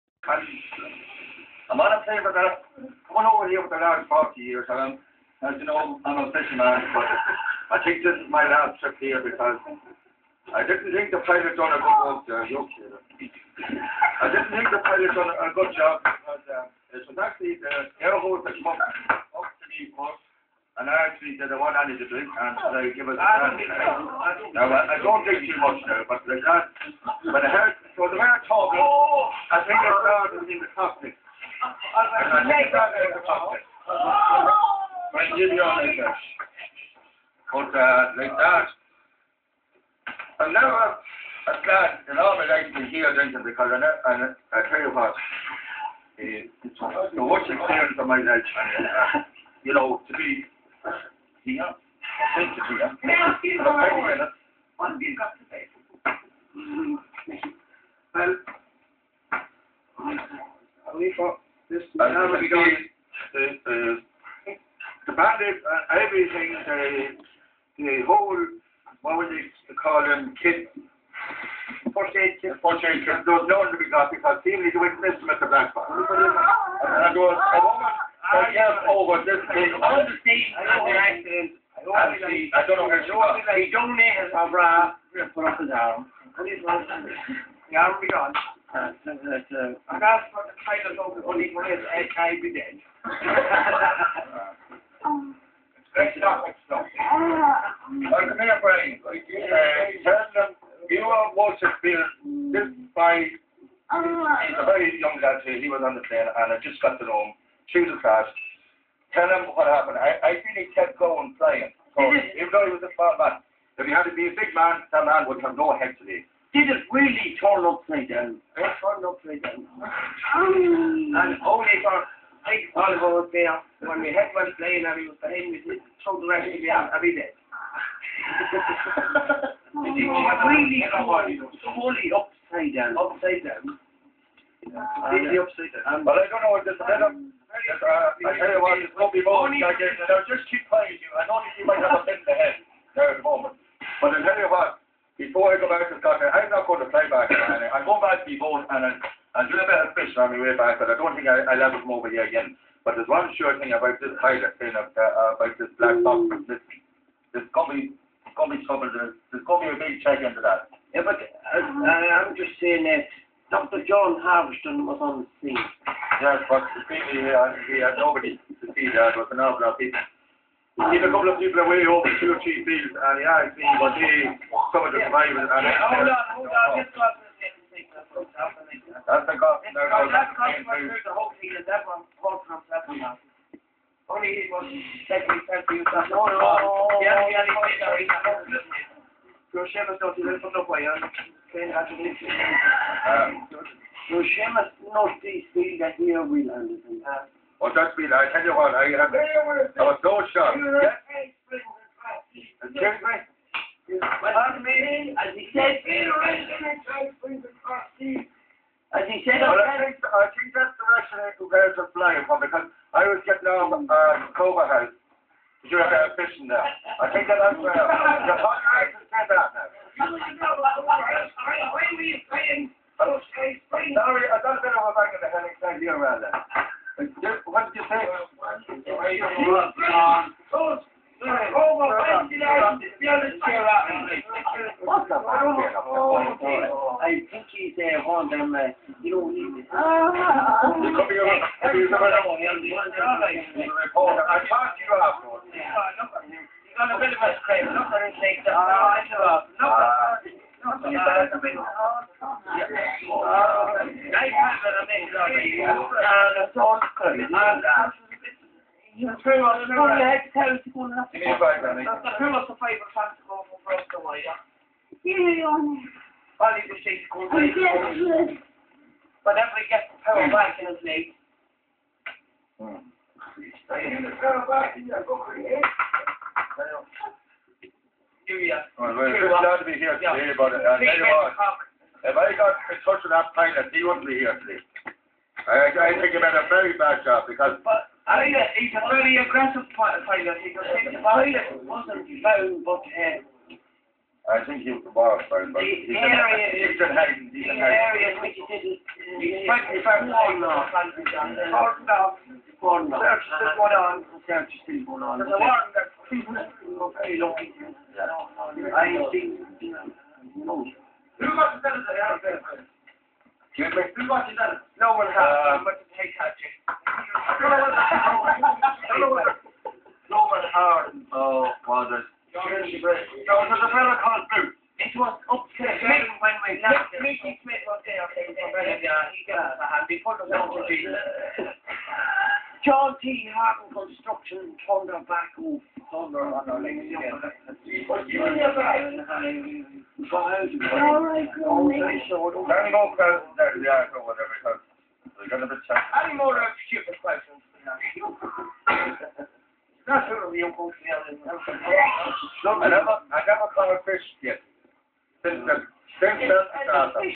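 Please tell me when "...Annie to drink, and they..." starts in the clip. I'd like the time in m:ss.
0:21.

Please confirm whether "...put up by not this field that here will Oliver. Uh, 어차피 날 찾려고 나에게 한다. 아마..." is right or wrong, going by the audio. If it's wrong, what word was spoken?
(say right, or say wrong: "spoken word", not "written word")
wrong: "Anderson", not "Oliver".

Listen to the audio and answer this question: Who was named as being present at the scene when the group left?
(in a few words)
Mickey Smith.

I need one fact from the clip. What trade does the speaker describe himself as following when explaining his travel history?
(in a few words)
Fisherman.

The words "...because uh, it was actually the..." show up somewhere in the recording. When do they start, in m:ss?
0:16.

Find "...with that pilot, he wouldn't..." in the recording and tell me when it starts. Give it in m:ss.
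4:43.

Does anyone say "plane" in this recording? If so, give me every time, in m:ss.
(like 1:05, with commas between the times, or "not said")
0:02, 1:46.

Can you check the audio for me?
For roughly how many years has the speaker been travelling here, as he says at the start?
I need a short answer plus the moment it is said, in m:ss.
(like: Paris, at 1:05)
40 years, at 0:04.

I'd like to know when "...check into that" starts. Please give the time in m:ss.
2:40.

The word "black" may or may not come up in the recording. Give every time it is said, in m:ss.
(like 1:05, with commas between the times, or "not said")
1:15, 2:35.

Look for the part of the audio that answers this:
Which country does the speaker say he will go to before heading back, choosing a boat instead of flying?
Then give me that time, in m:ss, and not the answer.
2:26.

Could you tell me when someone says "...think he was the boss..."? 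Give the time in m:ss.
4:54.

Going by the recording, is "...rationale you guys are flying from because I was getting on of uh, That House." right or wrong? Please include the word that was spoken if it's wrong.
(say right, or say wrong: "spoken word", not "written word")
wrong: "Cobra", not "That".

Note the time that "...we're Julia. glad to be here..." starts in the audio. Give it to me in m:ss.
4:38.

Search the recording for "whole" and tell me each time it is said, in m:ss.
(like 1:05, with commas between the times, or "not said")
1:08, 3:01.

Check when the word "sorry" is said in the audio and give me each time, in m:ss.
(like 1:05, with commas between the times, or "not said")
3:07, 3:39.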